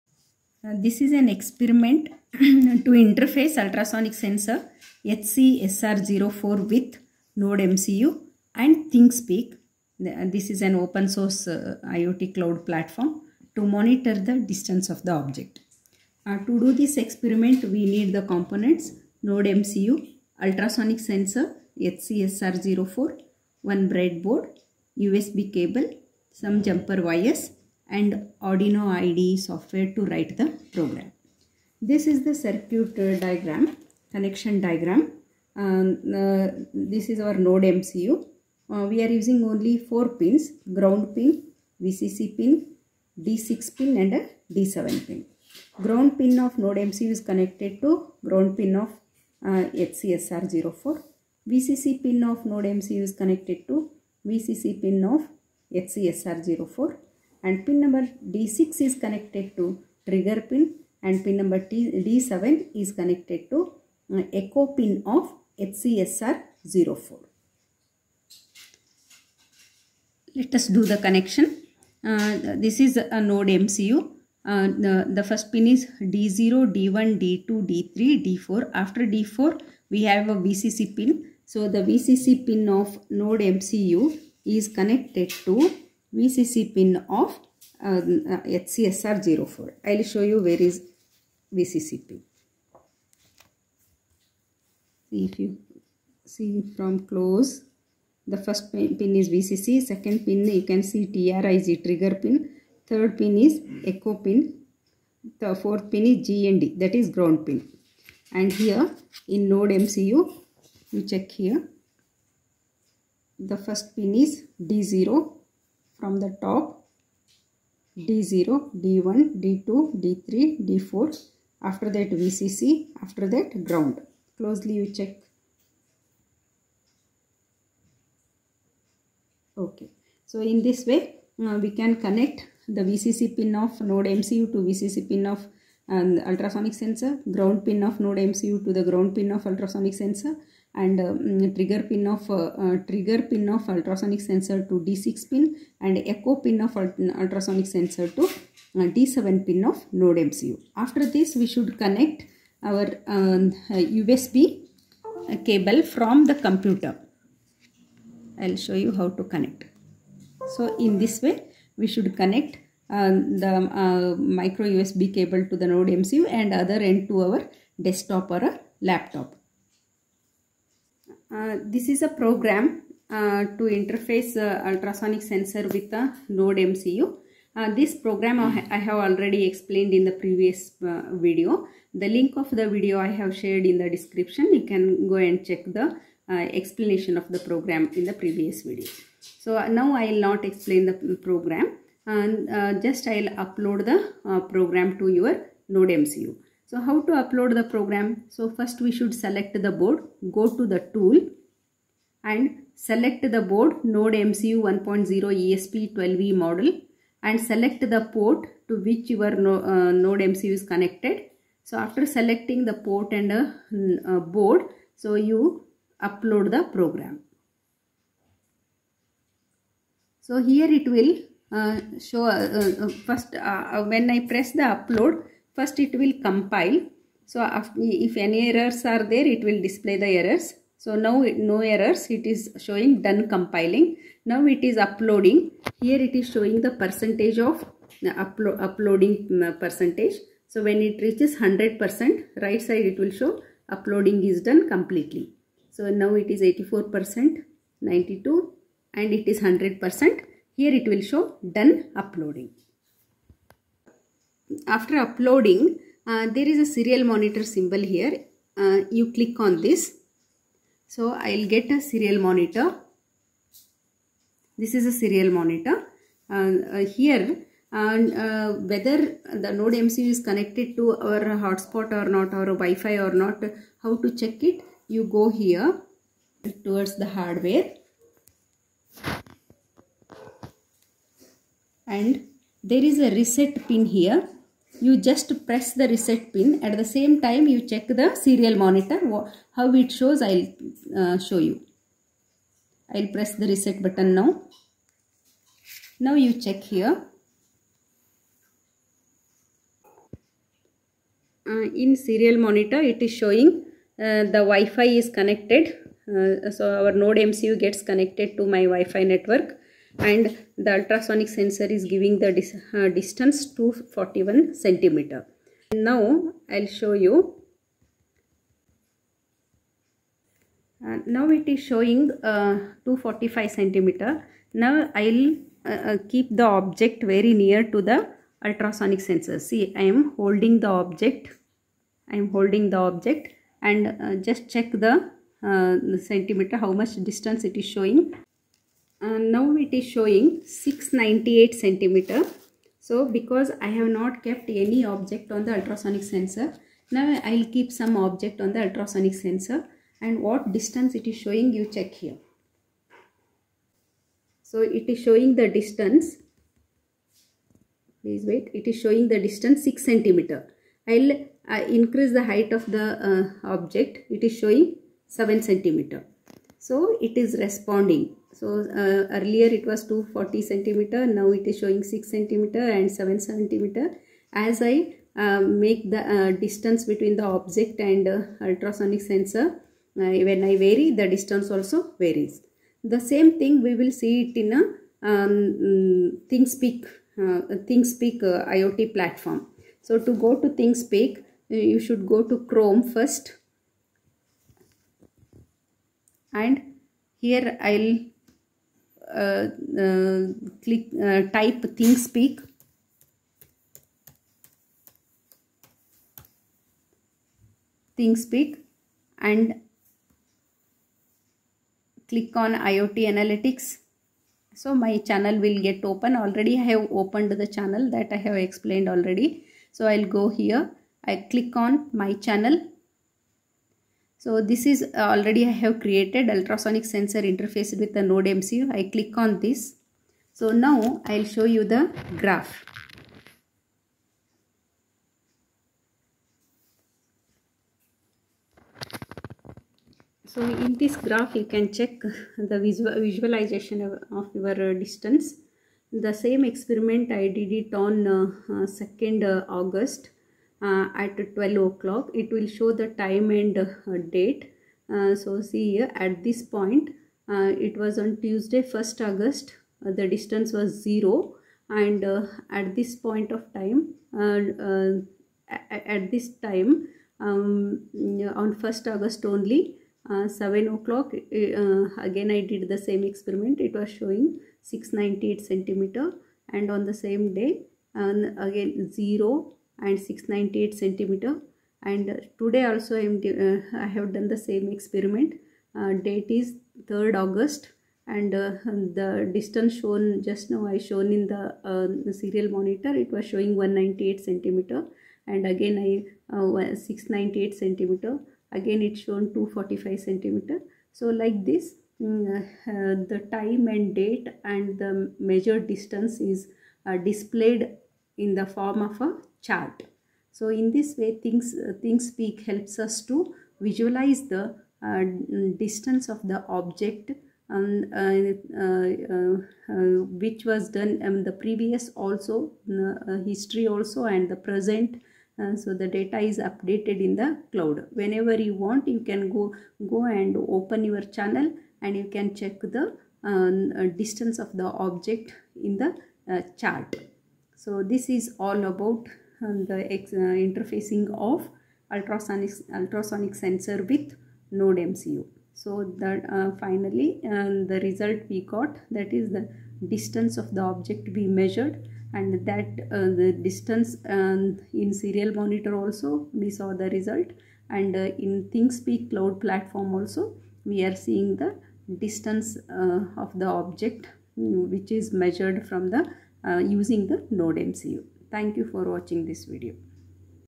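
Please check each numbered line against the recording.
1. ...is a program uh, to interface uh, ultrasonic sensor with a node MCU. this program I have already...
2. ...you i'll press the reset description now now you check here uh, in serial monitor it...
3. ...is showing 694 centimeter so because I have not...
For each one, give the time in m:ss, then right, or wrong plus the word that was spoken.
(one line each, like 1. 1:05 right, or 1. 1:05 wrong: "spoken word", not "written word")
1. 2:51 right
2. 4:51 wrong: "button", not "description"
3. 5:39 wrong: "698", not "694".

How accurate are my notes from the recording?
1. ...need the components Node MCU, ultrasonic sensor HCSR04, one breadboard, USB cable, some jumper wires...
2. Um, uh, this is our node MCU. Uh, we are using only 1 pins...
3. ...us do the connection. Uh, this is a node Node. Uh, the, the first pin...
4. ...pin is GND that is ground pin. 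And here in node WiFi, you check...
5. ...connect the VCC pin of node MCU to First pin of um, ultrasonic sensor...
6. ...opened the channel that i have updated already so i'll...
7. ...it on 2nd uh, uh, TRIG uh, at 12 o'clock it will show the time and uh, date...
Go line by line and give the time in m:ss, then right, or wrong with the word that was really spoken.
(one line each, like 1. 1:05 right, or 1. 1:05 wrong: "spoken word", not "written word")
1. 0:17 right
2. 0:35 wrong: "4", not "1"
3. 1:10 wrong: "MCU", not "Node"
4. 1:45 wrong: "MCU", not "WiFi"
5. 2:12 wrong: "VCC", not "First"
6. 6:56 wrong: "explained", not "updated"
7. 7:27 wrong: "August", not "TRIG".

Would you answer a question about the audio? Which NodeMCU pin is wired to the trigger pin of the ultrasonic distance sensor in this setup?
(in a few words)
D6.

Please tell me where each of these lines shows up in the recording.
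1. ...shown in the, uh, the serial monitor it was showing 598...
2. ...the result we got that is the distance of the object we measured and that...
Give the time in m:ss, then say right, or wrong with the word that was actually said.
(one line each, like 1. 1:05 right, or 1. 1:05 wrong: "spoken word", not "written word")
1. 8:10 wrong: "198", not "598"
2. 9:07 right.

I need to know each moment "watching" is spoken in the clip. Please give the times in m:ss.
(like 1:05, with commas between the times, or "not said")
9:28.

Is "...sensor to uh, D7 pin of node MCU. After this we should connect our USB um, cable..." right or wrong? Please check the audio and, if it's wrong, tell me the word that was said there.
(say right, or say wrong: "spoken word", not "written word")
right.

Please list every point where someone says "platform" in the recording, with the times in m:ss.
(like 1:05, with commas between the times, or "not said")
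0:12, 6:28, 9:19.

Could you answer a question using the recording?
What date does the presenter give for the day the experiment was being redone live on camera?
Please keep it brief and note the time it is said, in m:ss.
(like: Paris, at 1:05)
3rd August, at 8:06.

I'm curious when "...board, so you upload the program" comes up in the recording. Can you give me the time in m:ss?
3:34.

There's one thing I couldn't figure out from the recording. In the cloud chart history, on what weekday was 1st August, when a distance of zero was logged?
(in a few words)
Tuesday.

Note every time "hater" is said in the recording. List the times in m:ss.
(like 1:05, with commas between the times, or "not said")
not said.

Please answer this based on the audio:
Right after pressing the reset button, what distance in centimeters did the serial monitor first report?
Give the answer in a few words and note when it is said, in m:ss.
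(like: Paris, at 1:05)
241 centimeters, at 5:13.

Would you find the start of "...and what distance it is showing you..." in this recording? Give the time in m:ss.
5:50.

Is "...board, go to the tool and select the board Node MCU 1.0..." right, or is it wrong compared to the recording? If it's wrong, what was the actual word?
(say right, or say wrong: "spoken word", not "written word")
right.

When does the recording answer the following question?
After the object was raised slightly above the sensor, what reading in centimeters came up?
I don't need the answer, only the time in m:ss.
6:04.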